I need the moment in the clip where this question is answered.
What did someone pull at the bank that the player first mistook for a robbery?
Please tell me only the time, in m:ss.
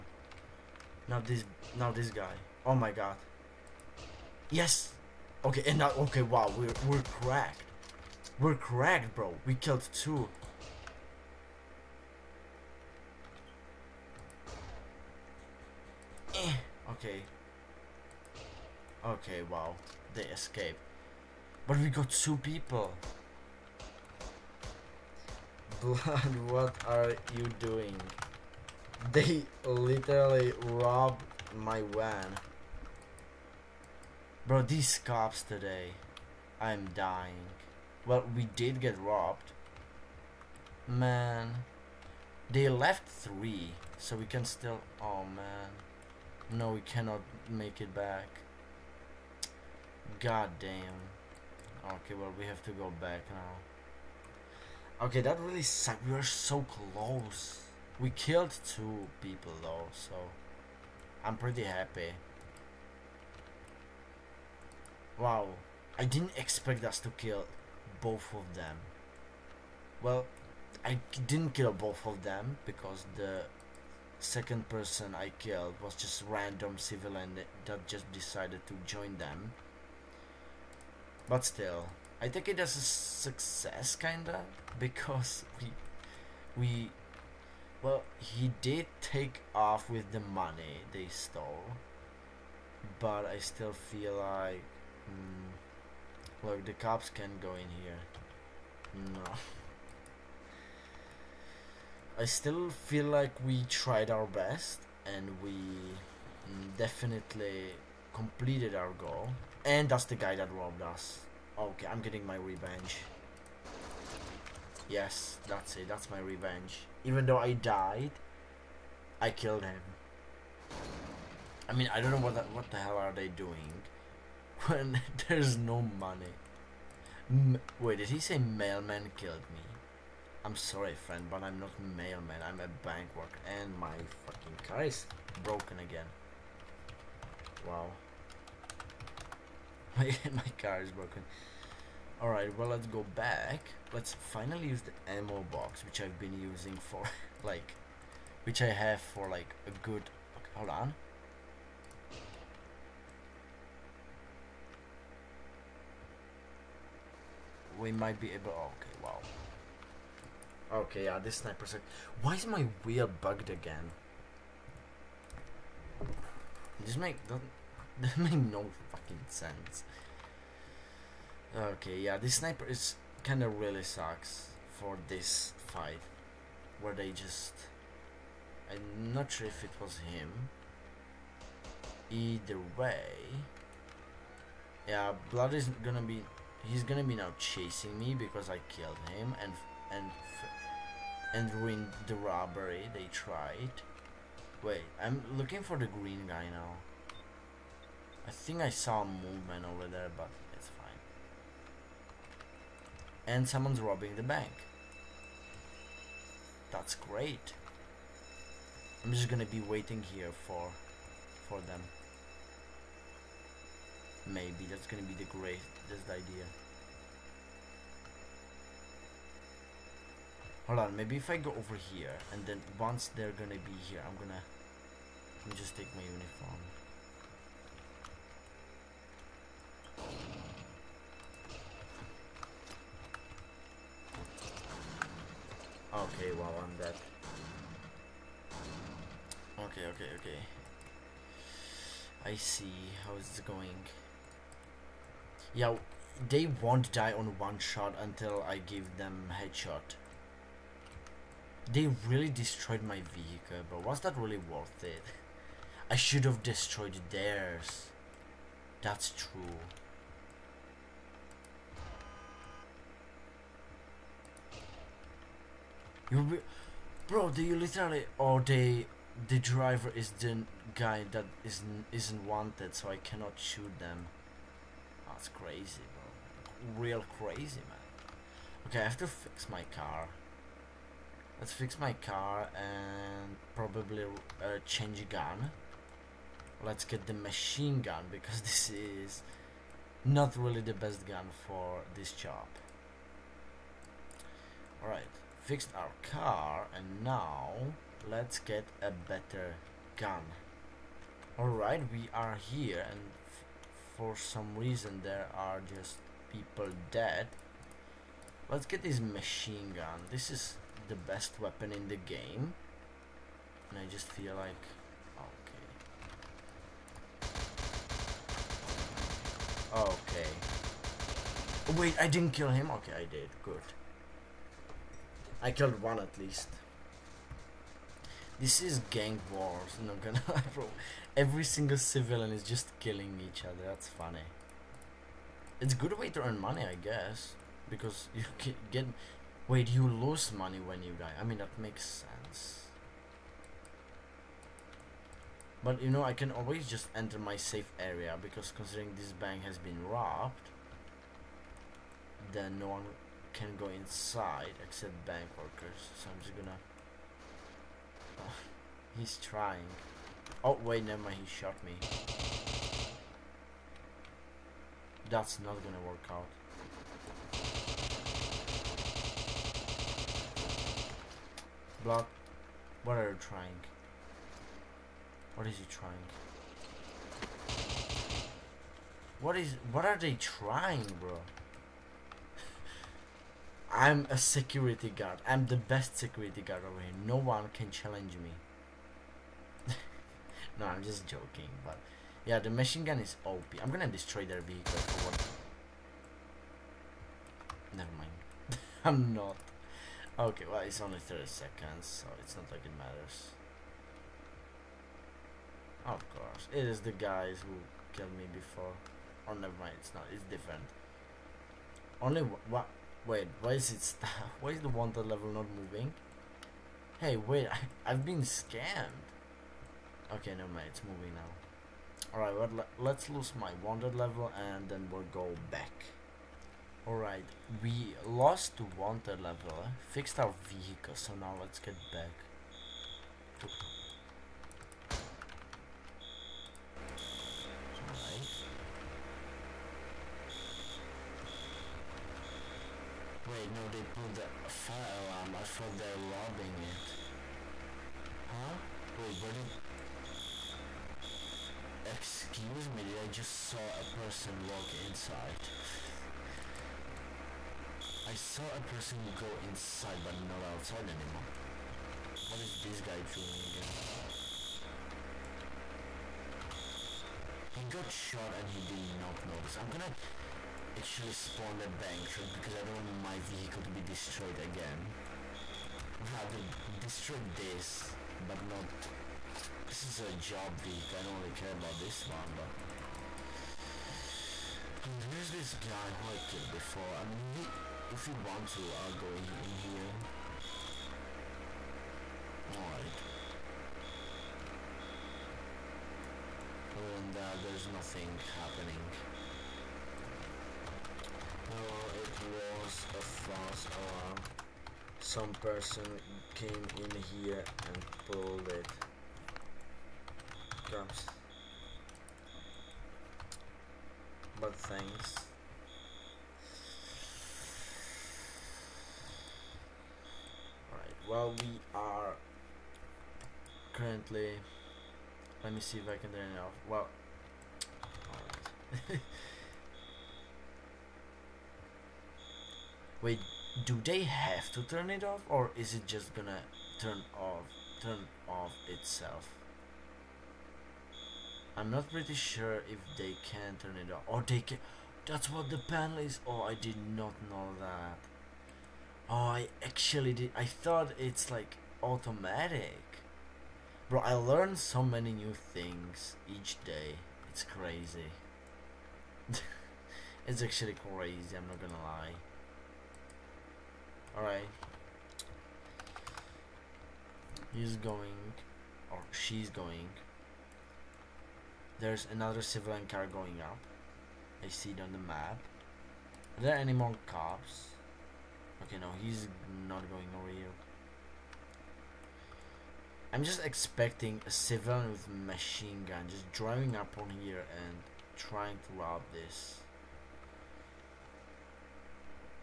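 7:23.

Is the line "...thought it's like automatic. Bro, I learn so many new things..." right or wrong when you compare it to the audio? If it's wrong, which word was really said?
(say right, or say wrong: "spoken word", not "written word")
right.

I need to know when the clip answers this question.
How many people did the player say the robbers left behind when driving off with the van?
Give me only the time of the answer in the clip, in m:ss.
0:42.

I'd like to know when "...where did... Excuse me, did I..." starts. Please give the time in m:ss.
7:29.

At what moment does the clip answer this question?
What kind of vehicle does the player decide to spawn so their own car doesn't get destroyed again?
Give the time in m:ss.
7:51.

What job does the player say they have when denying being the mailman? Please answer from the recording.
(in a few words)
bank worker.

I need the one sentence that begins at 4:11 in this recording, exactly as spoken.
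They really destroyed my vehicle, but was that really worth it?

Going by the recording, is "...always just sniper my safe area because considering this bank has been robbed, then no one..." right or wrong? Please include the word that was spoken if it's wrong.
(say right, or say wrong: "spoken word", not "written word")
wrong: "enter", not "sniper".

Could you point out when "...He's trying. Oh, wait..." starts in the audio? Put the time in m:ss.
5:58.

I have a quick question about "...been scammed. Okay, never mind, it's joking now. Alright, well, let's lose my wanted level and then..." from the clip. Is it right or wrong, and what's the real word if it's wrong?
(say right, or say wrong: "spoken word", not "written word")
wrong: "moving", not "joking".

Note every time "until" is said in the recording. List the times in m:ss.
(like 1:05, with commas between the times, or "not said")
4:08.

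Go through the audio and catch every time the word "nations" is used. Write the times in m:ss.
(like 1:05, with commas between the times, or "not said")
not said.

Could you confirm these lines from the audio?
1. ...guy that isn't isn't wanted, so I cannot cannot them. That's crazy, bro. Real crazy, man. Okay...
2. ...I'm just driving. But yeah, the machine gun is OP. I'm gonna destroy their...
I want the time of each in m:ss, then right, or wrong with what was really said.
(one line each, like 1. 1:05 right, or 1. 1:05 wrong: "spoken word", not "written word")
1. 4:30 wrong: "shoot", not "cannot"
2. 6:30 wrong: "joking", not "driving".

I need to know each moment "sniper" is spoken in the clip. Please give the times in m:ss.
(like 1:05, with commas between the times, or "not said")
2:41, 2:52.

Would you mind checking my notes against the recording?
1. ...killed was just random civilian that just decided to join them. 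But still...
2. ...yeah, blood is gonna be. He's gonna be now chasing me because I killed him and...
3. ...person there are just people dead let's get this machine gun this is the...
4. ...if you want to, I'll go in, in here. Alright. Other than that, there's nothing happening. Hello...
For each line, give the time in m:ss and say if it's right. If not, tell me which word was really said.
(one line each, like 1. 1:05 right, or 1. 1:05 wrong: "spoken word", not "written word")
1. 1:15 right
2. 3:04 right
3. 5:04 wrong: "reason", not "person"
4. 8:07 right.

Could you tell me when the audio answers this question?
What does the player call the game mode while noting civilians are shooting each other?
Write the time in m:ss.
5:28.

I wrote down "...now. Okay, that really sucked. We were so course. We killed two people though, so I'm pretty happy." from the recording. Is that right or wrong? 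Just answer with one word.
wrong.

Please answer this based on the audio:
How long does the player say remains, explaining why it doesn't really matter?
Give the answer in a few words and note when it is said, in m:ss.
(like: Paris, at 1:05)
30 seconds, at 6:40.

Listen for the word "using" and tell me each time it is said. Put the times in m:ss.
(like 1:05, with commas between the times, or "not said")
2:26.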